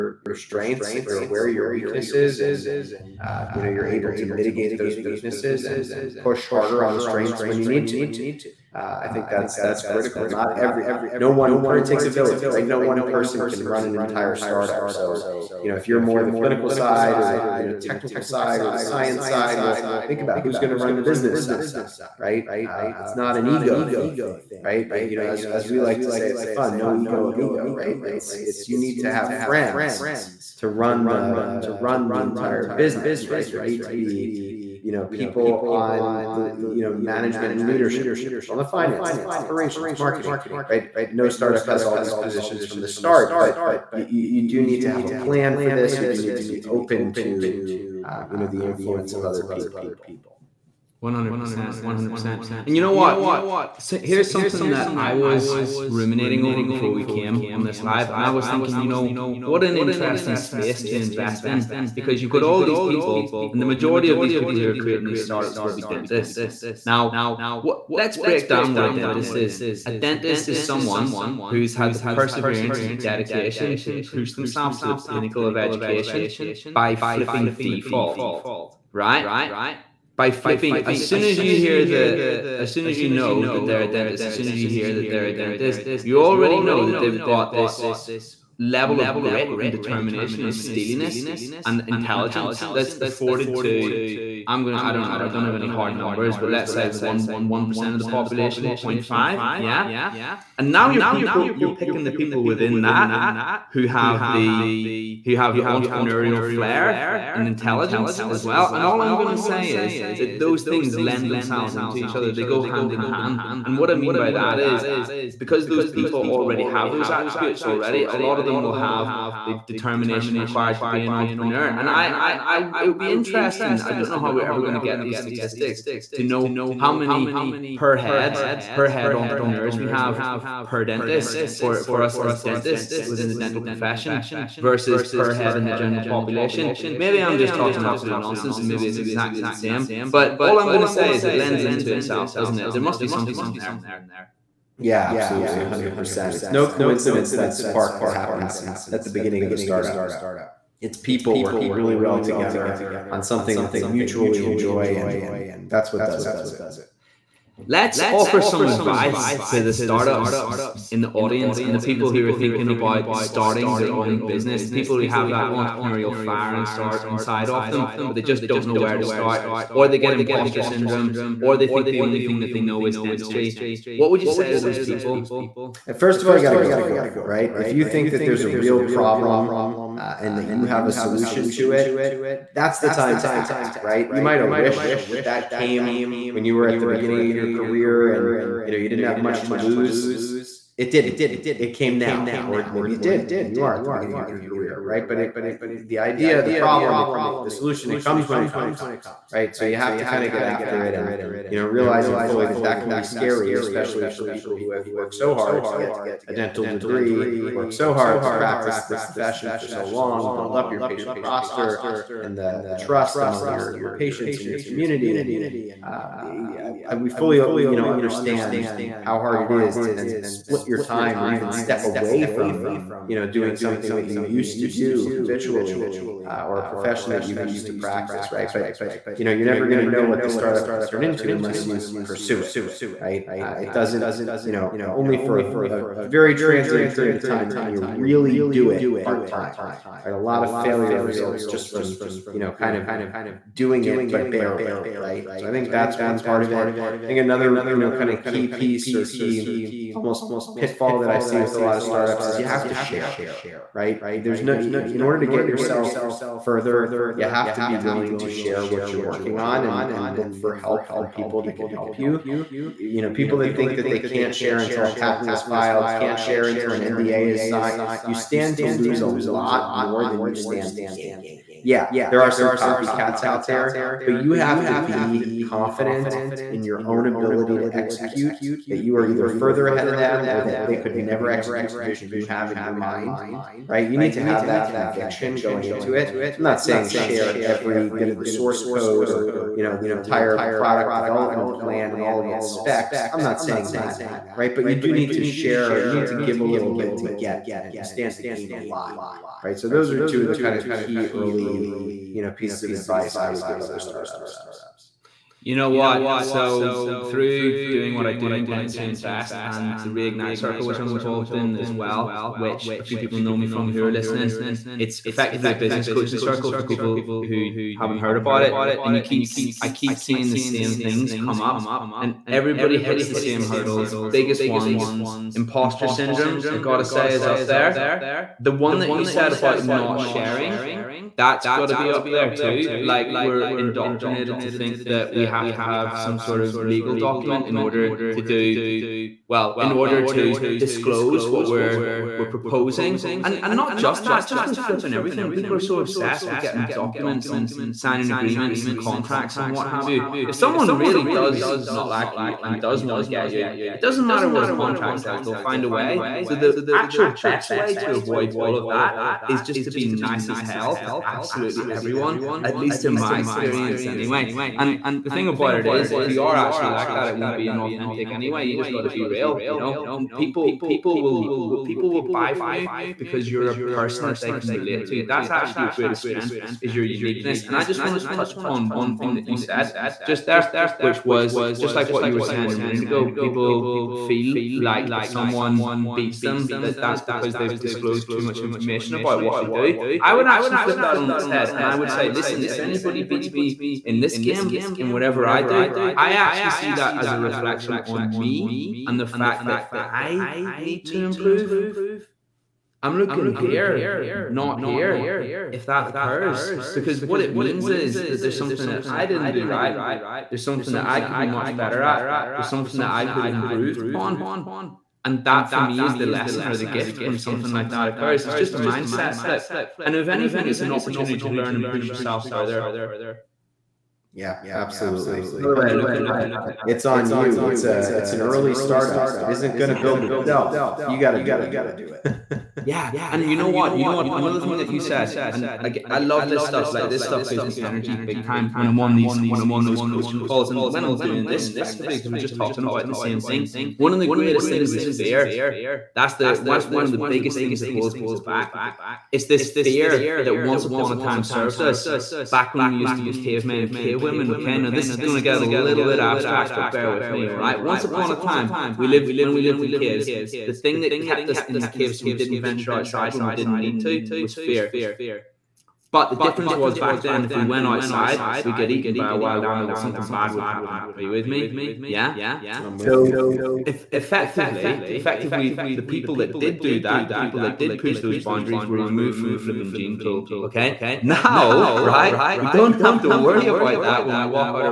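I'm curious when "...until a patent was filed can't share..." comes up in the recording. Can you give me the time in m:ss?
4:24.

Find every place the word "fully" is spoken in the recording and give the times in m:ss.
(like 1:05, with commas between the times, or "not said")
3:22, 3:37.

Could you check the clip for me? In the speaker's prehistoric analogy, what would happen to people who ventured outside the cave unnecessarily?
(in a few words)
Eaten by a wild animal.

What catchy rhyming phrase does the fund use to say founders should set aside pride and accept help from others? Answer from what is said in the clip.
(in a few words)
No ego amigo.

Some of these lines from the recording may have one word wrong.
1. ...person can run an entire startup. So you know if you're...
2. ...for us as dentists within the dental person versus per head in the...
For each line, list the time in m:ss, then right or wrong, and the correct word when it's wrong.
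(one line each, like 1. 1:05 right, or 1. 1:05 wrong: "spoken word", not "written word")
1. 0:13 right
2. 2:11 wrong: "profession", not "person".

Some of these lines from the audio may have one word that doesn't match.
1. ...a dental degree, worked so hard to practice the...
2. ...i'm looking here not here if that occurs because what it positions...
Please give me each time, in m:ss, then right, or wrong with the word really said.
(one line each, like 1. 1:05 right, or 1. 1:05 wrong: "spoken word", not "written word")
1. 3:26 right
2. 6:42 wrong: "means", not "positions".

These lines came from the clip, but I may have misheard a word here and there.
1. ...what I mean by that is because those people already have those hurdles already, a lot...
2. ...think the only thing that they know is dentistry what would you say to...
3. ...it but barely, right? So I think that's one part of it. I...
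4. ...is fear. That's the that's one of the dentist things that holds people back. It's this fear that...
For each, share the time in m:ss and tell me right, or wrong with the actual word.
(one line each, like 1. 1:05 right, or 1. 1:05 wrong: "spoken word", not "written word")
1. 1:53 wrong: "attributes", not "hurdles"
2. 2:51 right
3. 4:03 right
4. 7:24 wrong: "biggest", not "dentist".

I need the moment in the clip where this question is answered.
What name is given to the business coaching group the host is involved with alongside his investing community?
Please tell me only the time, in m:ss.
5:09.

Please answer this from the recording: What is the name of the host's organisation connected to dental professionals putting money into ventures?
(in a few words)
Dentists Who Invest.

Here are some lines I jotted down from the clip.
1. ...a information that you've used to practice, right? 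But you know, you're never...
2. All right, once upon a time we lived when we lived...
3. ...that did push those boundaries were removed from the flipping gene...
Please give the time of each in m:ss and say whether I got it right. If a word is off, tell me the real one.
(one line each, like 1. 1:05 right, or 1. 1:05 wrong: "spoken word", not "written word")
1. 3:46 wrong: "profession", not "information"
2. 7:37 right
3. 7:57 right.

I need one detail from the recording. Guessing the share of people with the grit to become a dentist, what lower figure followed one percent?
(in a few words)
0.5.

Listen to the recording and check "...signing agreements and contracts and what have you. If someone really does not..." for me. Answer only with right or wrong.
right.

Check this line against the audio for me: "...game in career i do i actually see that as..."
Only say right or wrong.
wrong.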